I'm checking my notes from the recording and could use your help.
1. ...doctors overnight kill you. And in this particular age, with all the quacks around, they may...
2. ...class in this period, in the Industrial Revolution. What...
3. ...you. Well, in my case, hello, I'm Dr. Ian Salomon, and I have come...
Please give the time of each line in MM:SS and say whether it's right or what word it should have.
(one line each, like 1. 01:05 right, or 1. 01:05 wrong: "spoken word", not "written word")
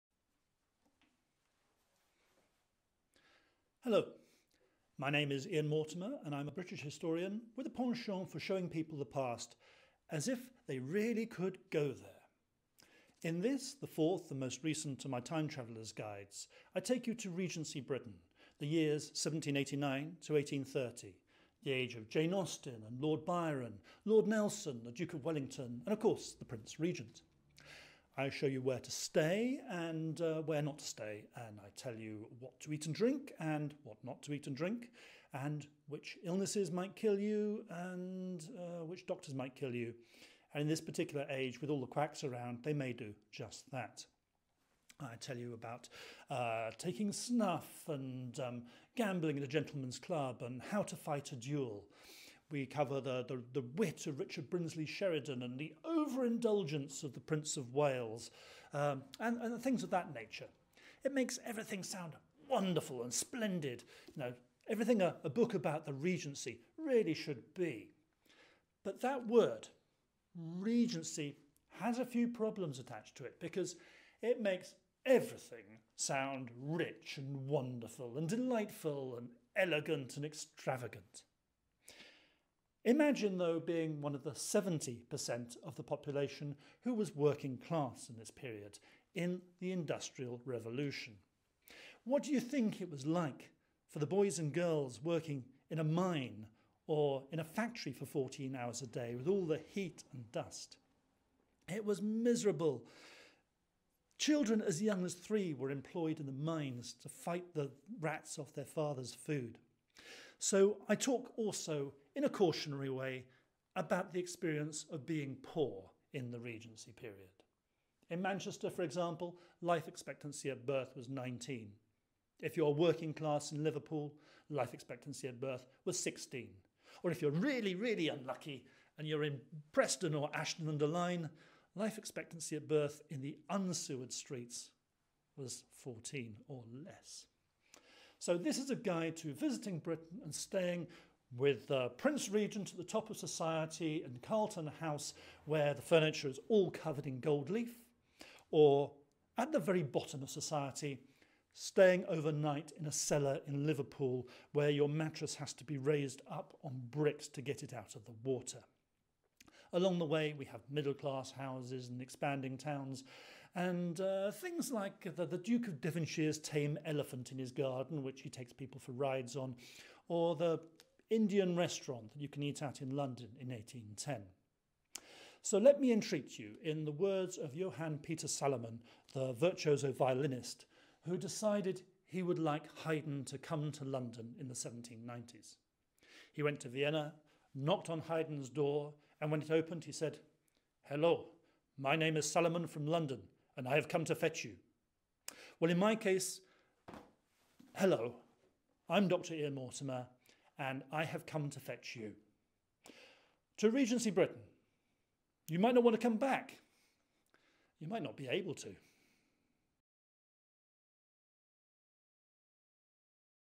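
1. 00:39 wrong: "might", not "overnight"
2. 01:27 right
3. 03:14 wrong: "Mortimer", not "Salomon".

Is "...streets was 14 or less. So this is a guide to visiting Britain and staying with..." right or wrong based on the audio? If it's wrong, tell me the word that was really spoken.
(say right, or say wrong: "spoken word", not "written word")
right.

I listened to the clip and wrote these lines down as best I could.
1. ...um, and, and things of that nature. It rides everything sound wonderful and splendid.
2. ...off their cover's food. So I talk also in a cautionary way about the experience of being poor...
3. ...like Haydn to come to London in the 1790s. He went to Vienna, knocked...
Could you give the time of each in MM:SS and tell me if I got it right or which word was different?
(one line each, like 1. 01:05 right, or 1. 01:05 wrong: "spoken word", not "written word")
1. 00:58 wrong: "makes", not "rides"
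2. 01:48 wrong: "father", not "cover"
3. 03:02 right.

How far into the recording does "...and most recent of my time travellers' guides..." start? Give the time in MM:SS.
00:14.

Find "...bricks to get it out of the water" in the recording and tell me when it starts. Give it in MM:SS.
02:36.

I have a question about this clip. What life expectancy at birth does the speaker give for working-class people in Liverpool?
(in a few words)
16.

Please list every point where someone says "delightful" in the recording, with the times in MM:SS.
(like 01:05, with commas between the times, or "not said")
01:18.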